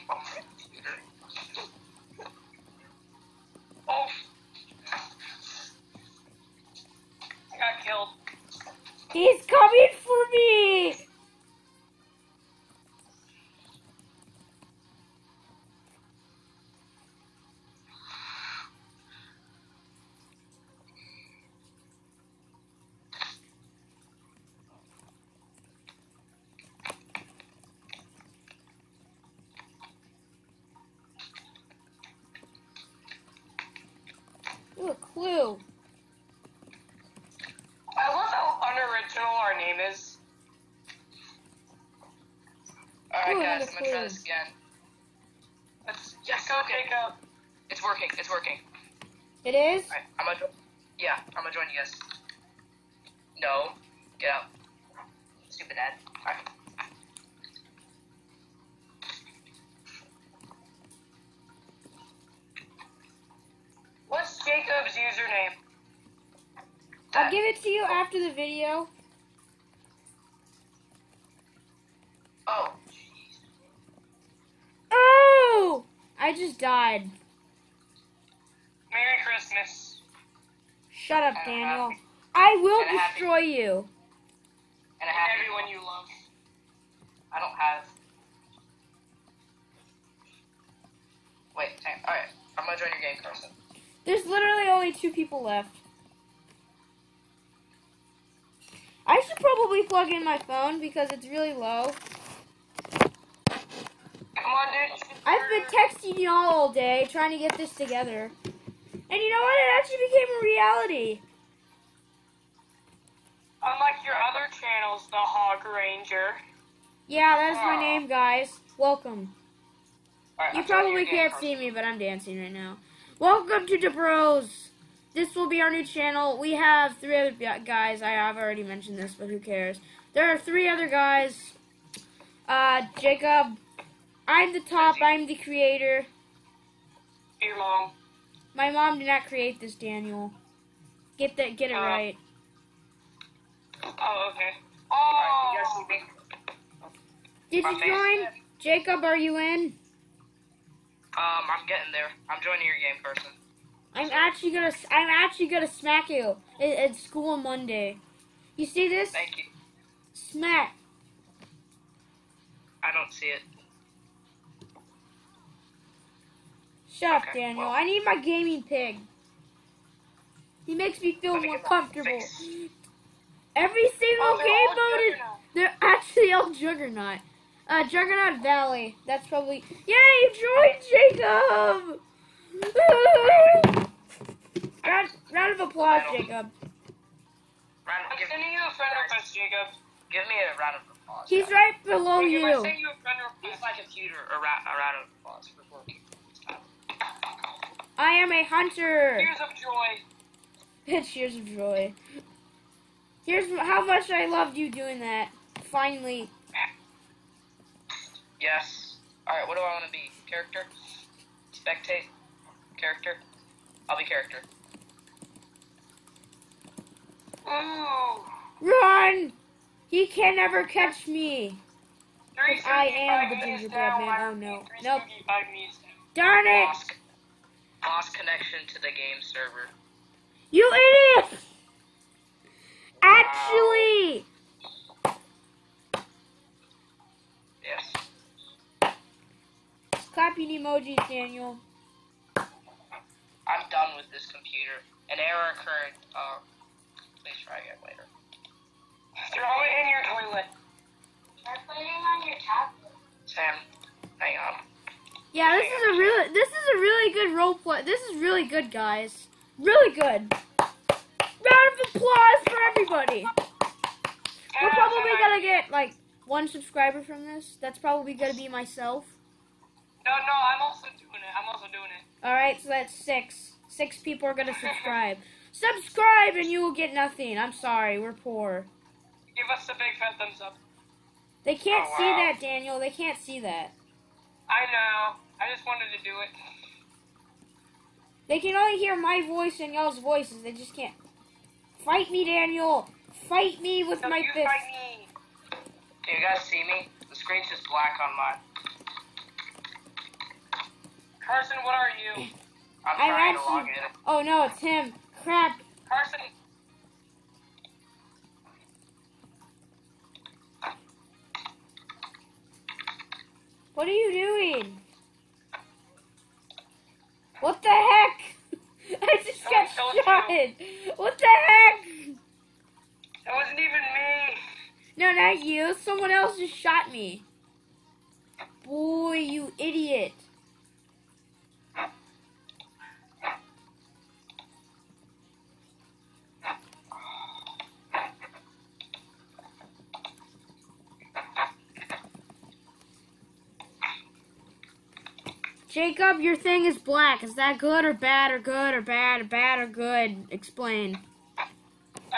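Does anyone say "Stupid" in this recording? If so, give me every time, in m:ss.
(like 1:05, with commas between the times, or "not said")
0:55.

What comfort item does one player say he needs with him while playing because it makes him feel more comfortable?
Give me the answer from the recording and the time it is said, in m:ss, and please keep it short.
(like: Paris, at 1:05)
gaming pig, at 2:48.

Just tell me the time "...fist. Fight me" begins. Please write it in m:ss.
4:54.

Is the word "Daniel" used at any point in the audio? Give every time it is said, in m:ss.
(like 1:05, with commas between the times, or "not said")
1:21, 2:19, 2:47, 4:01, 4:42, 4:52.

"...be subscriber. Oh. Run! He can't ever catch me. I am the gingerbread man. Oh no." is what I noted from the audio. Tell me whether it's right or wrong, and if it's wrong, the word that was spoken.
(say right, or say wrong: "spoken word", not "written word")
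wrong: "character", not "subscriber".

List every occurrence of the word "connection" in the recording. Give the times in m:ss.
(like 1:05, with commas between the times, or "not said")
3:48.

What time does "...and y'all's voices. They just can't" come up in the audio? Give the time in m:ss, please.
4:49.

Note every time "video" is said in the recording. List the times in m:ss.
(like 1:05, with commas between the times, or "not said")
1:08.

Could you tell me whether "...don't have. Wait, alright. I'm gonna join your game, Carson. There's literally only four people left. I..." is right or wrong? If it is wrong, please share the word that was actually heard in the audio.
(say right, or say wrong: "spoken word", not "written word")
wrong: "two", not "four".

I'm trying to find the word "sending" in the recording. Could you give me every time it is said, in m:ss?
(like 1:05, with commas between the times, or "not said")
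3:08, 3:12.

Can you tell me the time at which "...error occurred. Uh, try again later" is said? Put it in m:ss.
4:05.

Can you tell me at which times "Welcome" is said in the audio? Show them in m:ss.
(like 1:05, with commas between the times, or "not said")
1:58, 2:03.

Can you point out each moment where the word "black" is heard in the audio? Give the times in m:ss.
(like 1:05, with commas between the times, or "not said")
4:57, 5:46.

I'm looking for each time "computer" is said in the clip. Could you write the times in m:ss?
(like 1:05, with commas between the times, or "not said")
0:00, 3:13, 4:04.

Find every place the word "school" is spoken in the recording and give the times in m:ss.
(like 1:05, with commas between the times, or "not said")
2:36.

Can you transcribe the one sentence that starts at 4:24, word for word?
We're probably gonna get like one subscriber from this.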